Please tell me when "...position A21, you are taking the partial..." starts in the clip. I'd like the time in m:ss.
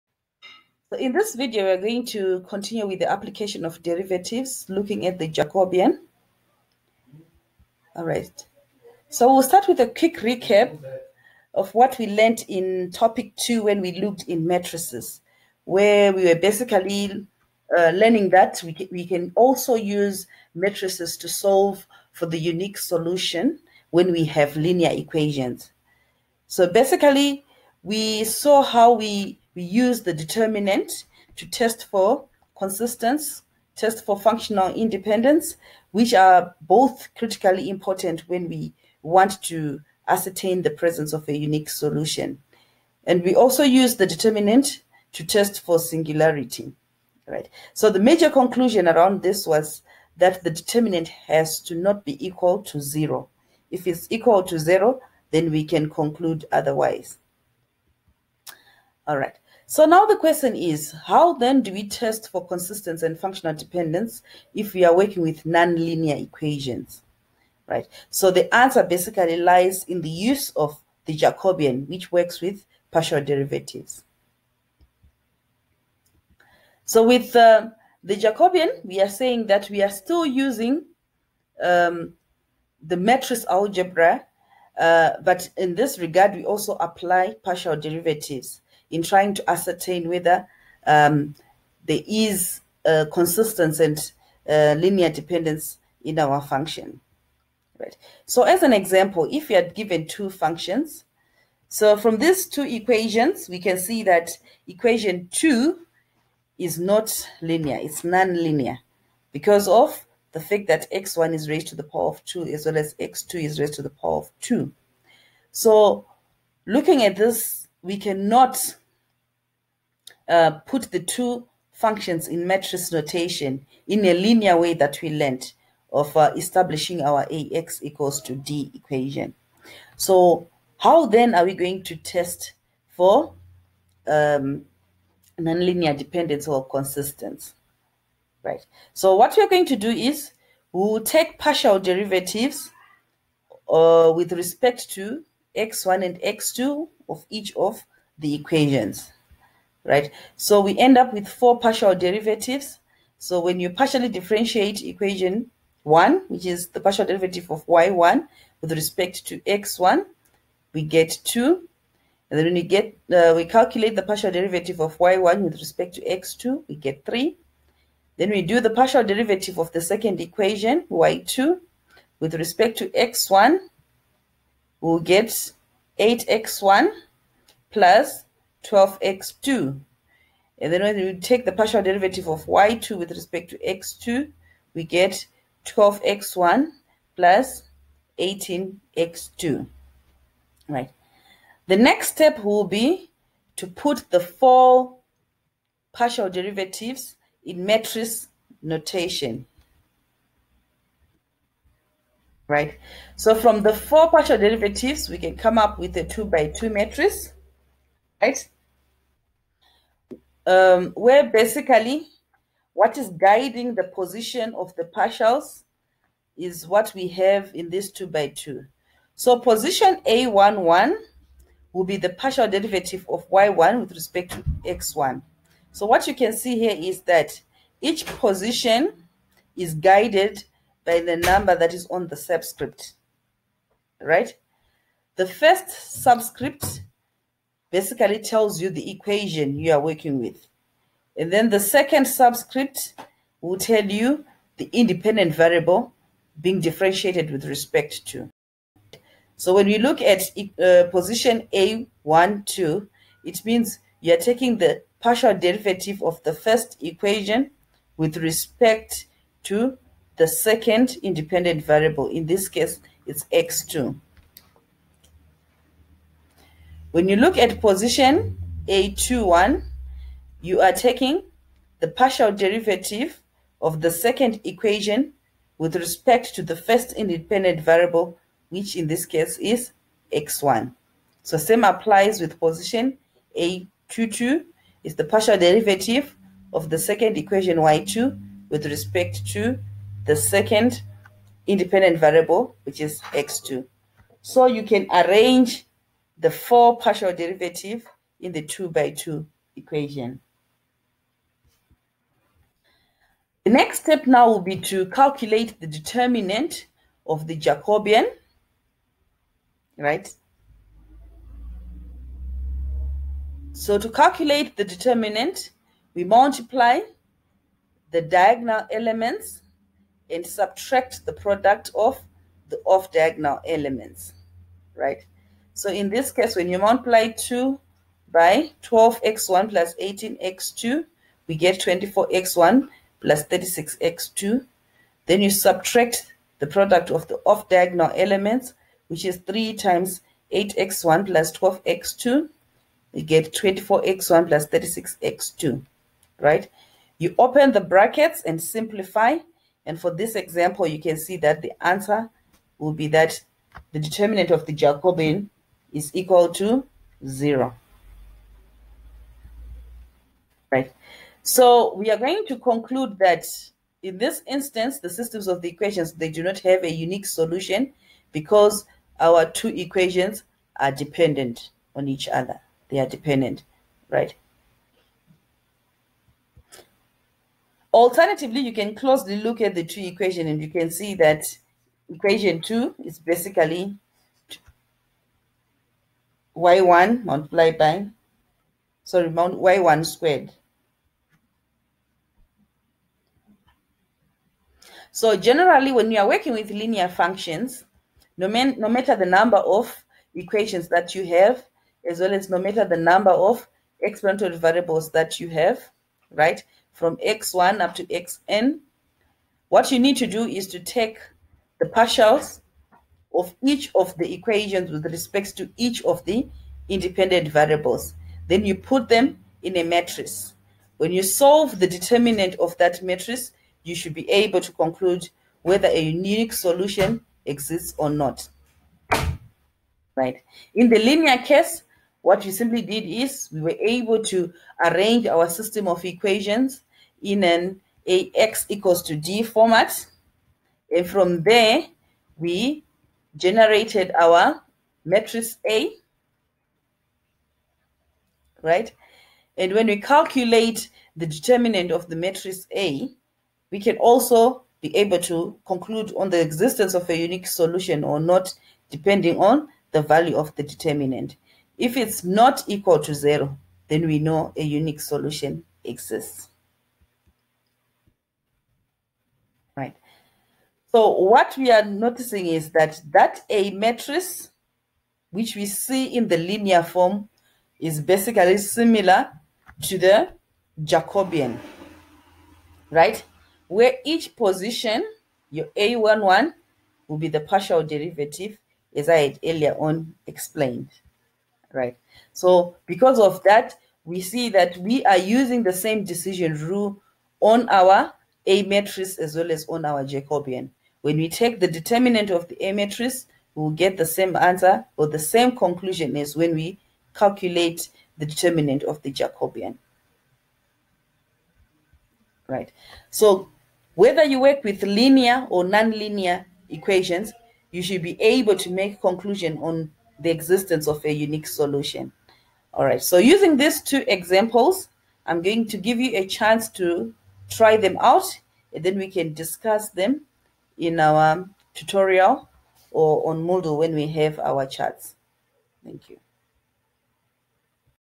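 4:27.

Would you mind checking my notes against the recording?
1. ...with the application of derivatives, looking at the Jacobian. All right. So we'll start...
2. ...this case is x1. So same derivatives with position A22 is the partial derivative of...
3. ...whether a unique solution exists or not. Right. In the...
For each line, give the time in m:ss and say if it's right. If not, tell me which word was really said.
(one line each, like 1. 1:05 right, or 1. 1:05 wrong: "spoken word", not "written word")
1. 0:02 right
2. 4:38 wrong: "applies", not "derivatives"
3. 7:05 right.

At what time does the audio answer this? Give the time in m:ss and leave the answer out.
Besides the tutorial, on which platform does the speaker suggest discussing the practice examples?
8:53.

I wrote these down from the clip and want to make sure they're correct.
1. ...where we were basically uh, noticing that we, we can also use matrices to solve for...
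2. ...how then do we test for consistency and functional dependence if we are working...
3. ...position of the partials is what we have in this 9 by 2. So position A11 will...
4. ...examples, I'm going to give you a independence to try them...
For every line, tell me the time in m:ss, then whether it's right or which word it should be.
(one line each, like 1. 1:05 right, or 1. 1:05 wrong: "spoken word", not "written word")
1. 0:15 wrong: "learning", not "noticing"
2. 1:01 right
3. 3:33 wrong: "2", not "9"
4. 8:43 wrong: "chance", not "independence".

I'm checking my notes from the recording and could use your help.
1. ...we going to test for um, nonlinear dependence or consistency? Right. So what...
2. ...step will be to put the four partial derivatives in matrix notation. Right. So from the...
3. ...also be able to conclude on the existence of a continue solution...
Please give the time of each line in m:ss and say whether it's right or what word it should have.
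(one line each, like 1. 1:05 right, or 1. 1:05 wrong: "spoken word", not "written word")
1. 2:11 right
2. 3:12 right
3. 7:33 wrong: "unique", not "continue".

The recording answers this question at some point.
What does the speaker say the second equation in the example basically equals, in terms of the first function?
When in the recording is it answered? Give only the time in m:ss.
6:29.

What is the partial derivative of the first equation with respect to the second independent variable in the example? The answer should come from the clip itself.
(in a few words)
3.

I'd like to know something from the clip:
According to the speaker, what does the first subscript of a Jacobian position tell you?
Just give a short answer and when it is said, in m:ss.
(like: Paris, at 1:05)
The equation, at 3:58.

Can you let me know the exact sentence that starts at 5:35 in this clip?
Then you subtract the product of the off-diagonal elements, which is 3 times 8x1 plus 12x2.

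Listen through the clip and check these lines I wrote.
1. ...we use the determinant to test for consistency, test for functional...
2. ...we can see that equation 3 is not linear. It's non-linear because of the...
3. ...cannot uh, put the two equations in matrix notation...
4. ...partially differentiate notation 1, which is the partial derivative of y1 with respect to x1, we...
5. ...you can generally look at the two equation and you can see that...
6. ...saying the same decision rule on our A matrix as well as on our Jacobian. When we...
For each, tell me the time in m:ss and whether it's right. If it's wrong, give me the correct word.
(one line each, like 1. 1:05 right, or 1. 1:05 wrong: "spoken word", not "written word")
1. 0:29 right
2. 1:43 wrong: "2", not "3"
3. 1:57 wrong: "functions", not "equations"
4. 2:33 wrong: "equation", not "notation"
5. 6:18 wrong: "closely", not "generally"
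6. 8:14 wrong: "using", not "saying".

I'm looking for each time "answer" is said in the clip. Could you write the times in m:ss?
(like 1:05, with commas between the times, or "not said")
1:08, 5:51, 8:24.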